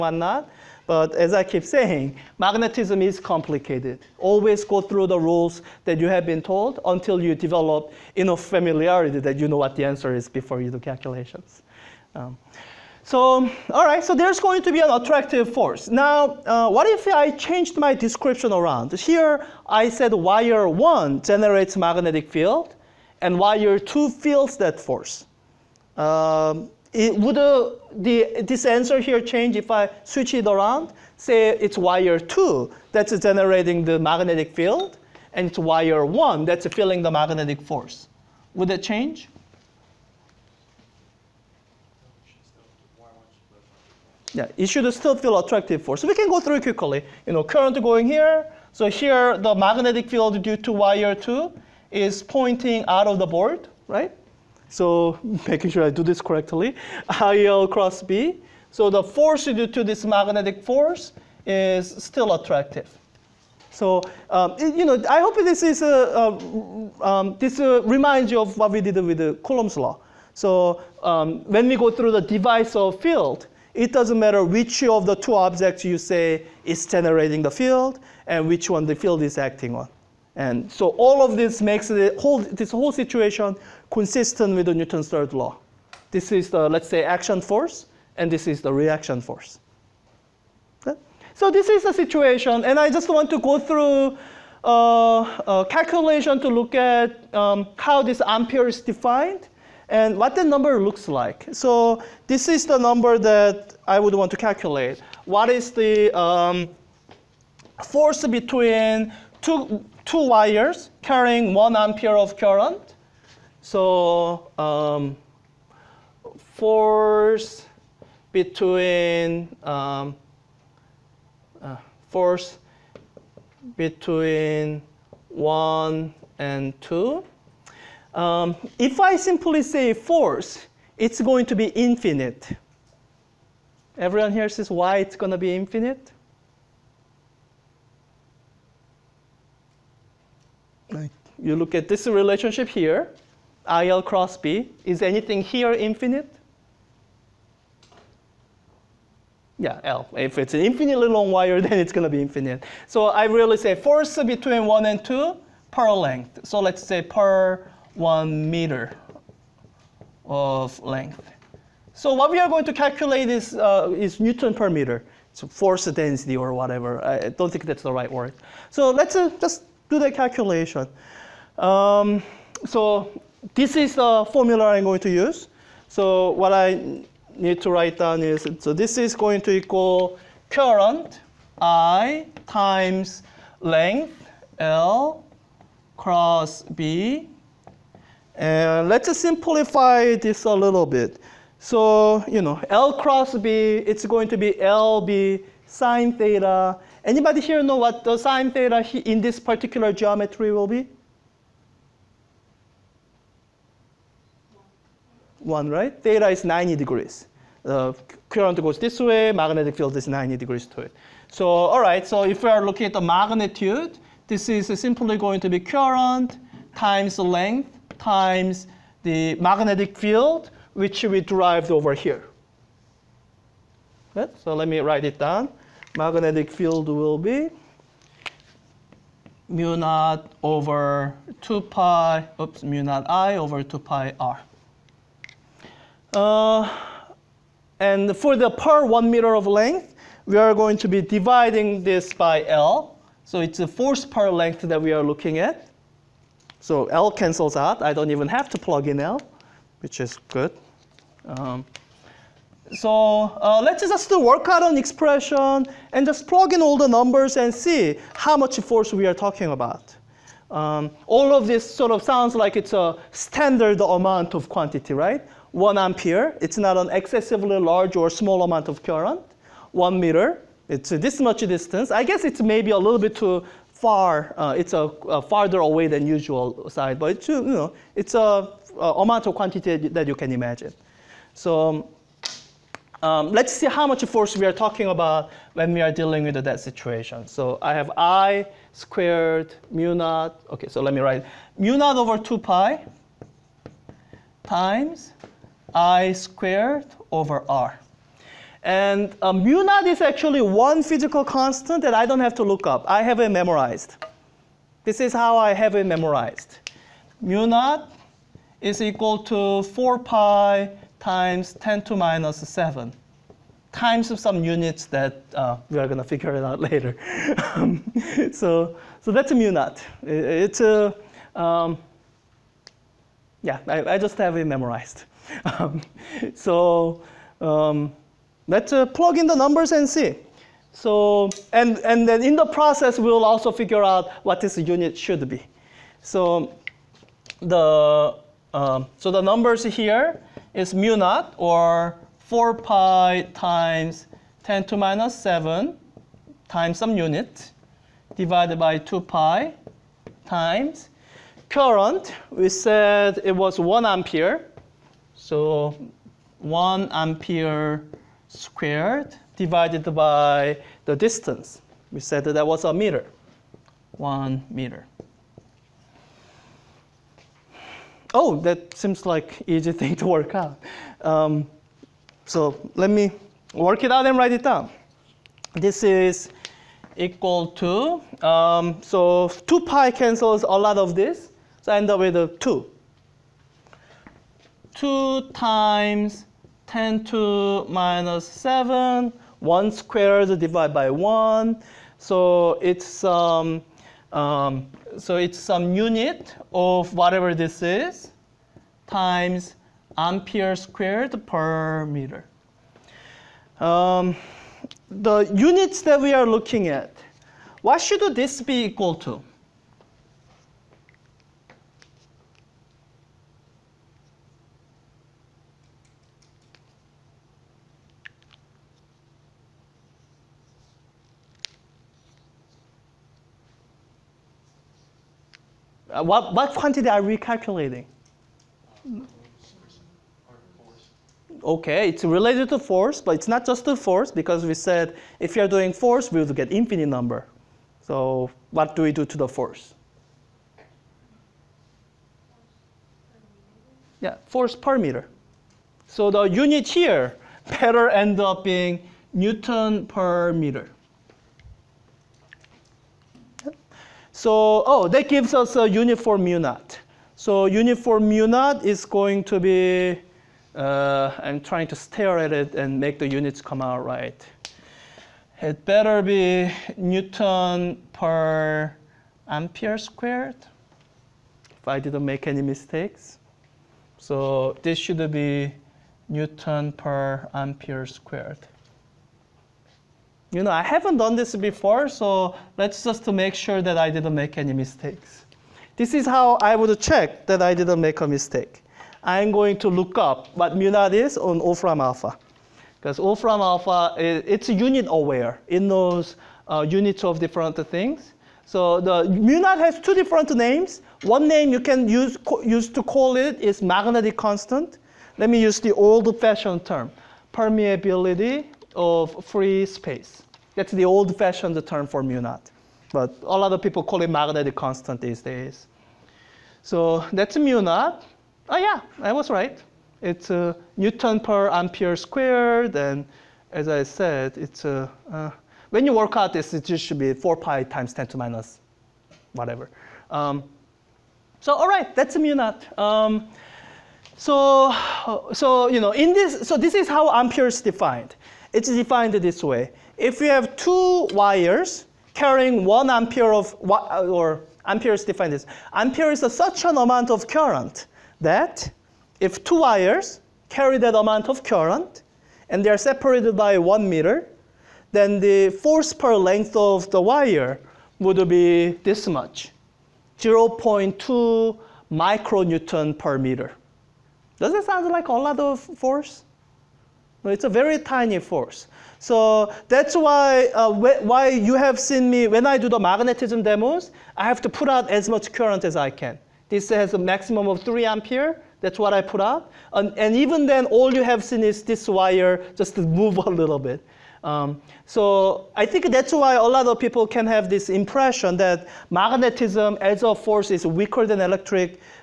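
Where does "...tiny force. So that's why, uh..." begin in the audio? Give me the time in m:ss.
9:27.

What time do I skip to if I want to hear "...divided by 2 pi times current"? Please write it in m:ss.
5:48.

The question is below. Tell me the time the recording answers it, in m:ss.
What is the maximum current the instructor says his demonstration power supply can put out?
9:37.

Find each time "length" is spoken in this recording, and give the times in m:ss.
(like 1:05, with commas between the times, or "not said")
2:35, 2:40, 3:03, 3:37, 3:59, 4:04, 9:16.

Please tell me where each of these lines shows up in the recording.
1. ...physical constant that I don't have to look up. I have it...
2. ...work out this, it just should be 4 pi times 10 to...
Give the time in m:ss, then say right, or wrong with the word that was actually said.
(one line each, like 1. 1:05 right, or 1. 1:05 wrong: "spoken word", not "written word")
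1. 5:00 right
2. 8:45 right.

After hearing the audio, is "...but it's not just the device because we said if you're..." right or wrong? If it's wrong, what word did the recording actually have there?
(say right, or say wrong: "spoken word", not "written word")
wrong: "force", not "device".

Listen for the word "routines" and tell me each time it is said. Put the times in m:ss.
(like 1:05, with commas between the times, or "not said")
not said.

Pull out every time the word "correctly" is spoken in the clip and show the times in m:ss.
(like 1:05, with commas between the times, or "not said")
0:56.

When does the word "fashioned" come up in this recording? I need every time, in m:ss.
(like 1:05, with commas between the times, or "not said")
8:25, 8:30.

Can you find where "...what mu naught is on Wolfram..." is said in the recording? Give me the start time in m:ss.
8:10.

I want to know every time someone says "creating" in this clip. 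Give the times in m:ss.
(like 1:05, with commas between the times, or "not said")
not said.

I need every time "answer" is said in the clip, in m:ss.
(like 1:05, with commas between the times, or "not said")
0:09, 0:28.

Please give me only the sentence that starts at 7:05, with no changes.
Uh, what, what quantity are we calculating?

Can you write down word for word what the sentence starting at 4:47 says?
So I have I squared mu naught.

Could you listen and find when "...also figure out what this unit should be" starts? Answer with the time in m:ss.
5:33.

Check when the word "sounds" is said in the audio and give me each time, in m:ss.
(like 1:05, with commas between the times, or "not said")
4:22, 9:24.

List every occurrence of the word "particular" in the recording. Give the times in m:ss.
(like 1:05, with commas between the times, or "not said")
3:19.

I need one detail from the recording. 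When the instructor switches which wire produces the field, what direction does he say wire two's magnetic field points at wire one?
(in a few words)
Out of the board.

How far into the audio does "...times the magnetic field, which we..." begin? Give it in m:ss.
3:37.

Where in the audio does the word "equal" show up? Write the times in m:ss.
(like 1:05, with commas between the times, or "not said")
2:59, 5:08, 6:16, 6:48.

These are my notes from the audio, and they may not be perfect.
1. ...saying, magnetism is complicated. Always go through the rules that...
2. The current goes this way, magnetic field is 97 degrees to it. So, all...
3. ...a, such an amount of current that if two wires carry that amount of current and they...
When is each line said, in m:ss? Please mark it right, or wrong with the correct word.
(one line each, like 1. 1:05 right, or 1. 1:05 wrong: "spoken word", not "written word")
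1. 0:01 right
2. 3:27 wrong: "90", not "97"
3. 9:06 right.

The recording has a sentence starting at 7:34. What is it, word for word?
So, oh, that gives us a uniform mu naught.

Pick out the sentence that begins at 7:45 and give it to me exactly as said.
It better be Newton per ampere squared, if I didn't make any mistakes.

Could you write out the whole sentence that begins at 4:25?
One ampere, it's not an excessively large or small amount of current.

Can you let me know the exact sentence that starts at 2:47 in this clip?
I don't think that's the right word.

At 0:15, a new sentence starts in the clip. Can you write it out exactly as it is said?
Now, uh, what if I changed my description around?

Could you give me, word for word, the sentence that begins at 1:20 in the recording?
And so all of this makes whole, this whole situation consistent with Newton's third law.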